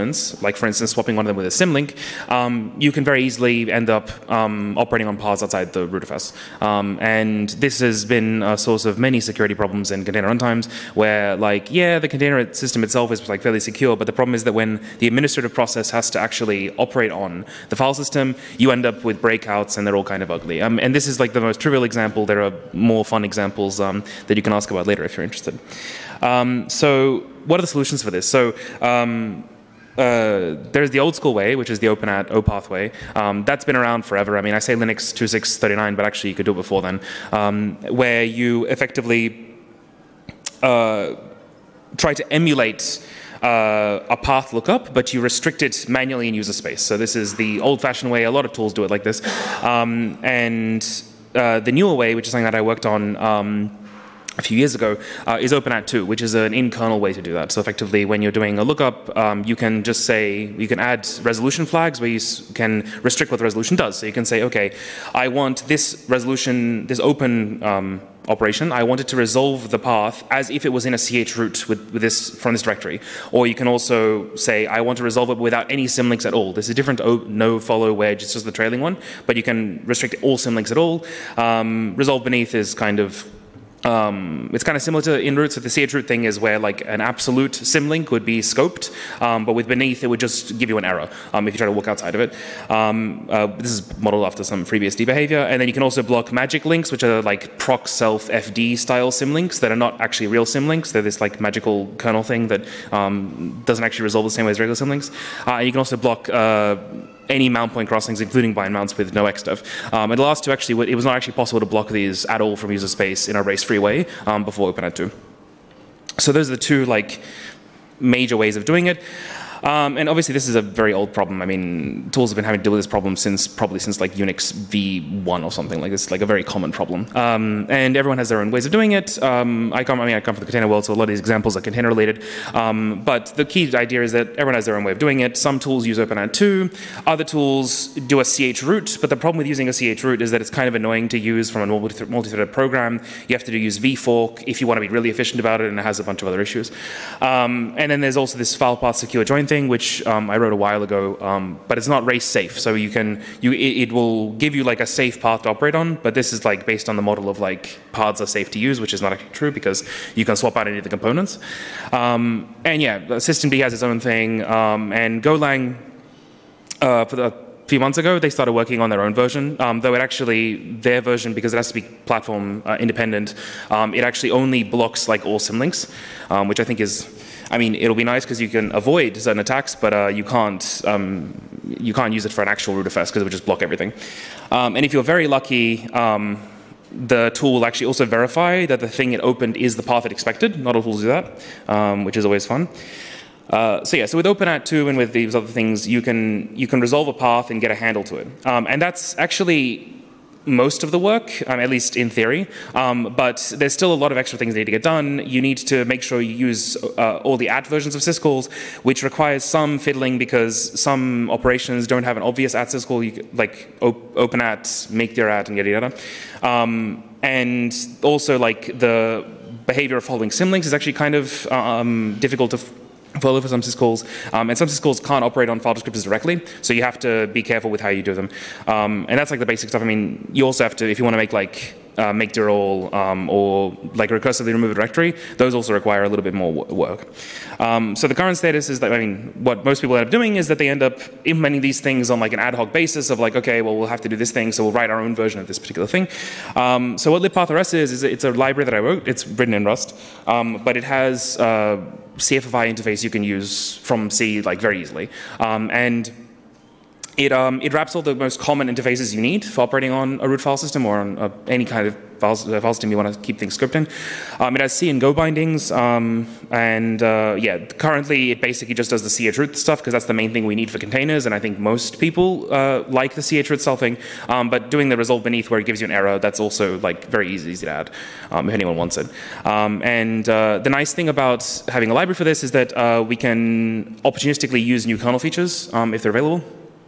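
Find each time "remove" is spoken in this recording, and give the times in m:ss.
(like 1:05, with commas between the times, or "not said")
3:54.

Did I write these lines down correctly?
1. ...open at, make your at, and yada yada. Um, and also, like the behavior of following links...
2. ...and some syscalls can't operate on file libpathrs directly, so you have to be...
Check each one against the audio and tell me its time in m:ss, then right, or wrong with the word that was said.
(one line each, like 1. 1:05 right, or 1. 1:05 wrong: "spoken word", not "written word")
1. 3:34 wrong: "symlinks", not "links"
2. 3:44 wrong: "descriptors", not "libpathrs".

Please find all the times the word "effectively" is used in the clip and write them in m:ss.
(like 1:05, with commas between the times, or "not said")
0:38, 0:57.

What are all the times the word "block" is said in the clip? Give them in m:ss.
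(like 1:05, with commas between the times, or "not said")
1:36, 1:45, 1:51, 2:54, 3:03.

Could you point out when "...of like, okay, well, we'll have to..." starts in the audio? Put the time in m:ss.
4:03.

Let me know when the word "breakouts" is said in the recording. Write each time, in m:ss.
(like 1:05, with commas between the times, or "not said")
0:19.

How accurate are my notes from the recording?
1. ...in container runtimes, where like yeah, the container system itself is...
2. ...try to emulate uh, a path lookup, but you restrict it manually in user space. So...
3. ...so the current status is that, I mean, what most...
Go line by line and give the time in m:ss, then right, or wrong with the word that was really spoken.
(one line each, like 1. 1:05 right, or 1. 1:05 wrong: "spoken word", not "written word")
1. 0:09 right
2. 0:41 right
3. 3:57 right.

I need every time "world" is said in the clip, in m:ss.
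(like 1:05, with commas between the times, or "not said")
2:10.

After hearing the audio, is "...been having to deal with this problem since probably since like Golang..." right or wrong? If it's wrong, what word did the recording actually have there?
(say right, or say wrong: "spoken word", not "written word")
wrong: "Unix", not "Golang".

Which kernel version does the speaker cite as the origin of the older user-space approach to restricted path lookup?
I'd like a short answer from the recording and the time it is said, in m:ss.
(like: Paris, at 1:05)
Linux 2.6.39, at 0:34.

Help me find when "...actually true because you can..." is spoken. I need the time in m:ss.
2:39.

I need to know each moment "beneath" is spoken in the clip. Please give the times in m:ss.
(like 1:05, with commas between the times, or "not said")
1:22, 1:29, 4:35.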